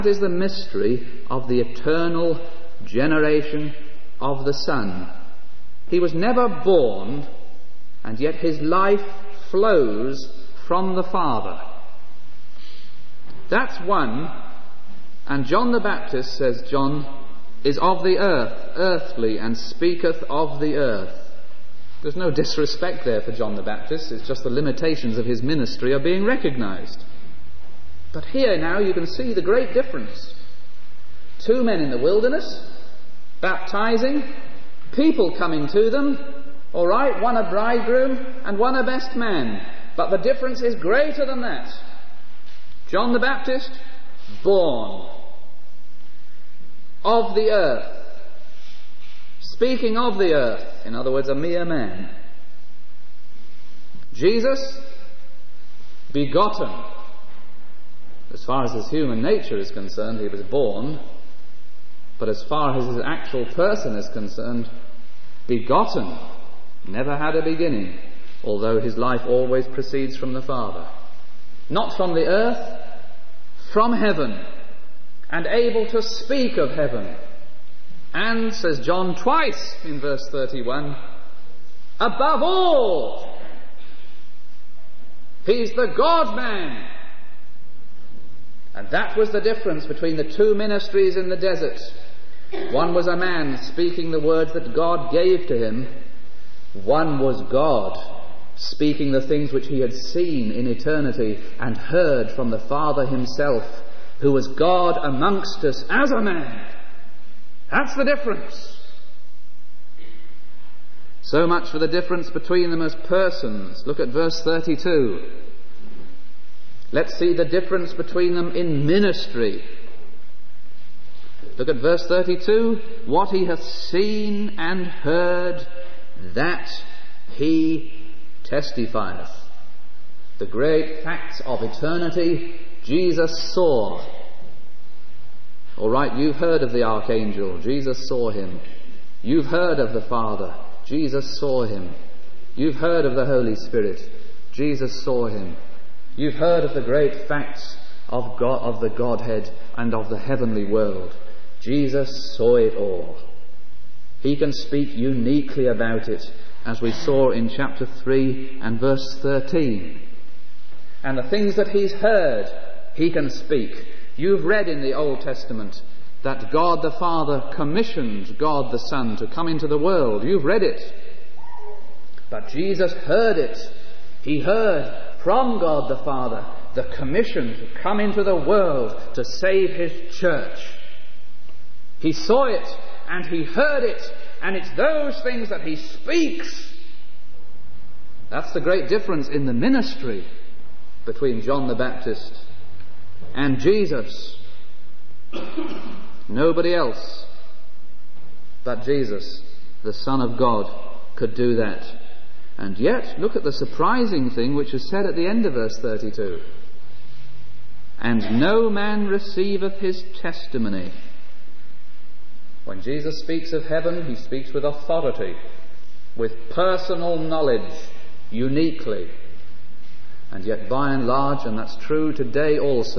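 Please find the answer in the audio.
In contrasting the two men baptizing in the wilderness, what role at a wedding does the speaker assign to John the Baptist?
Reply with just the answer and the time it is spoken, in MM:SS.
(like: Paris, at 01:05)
best man, at 00:38.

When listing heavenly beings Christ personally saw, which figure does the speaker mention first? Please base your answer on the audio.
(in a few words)
the archangel.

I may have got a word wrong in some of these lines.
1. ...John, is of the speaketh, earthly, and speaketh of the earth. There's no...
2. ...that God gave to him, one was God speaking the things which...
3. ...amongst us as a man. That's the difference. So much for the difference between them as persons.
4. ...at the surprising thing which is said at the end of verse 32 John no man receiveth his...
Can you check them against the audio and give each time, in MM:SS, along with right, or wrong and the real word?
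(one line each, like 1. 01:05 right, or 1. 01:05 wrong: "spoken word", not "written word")
1. 00:16 wrong: "earth", not "speaketh"
2. 01:34 right
3. 01:45 right
4. 03:23 wrong: "And", not "John".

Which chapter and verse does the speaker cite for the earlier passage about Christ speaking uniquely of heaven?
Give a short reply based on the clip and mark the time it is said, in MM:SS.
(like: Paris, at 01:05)
chapter 3, verse 13, at 02:37.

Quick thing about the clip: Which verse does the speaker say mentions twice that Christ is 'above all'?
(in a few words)
Verse 31.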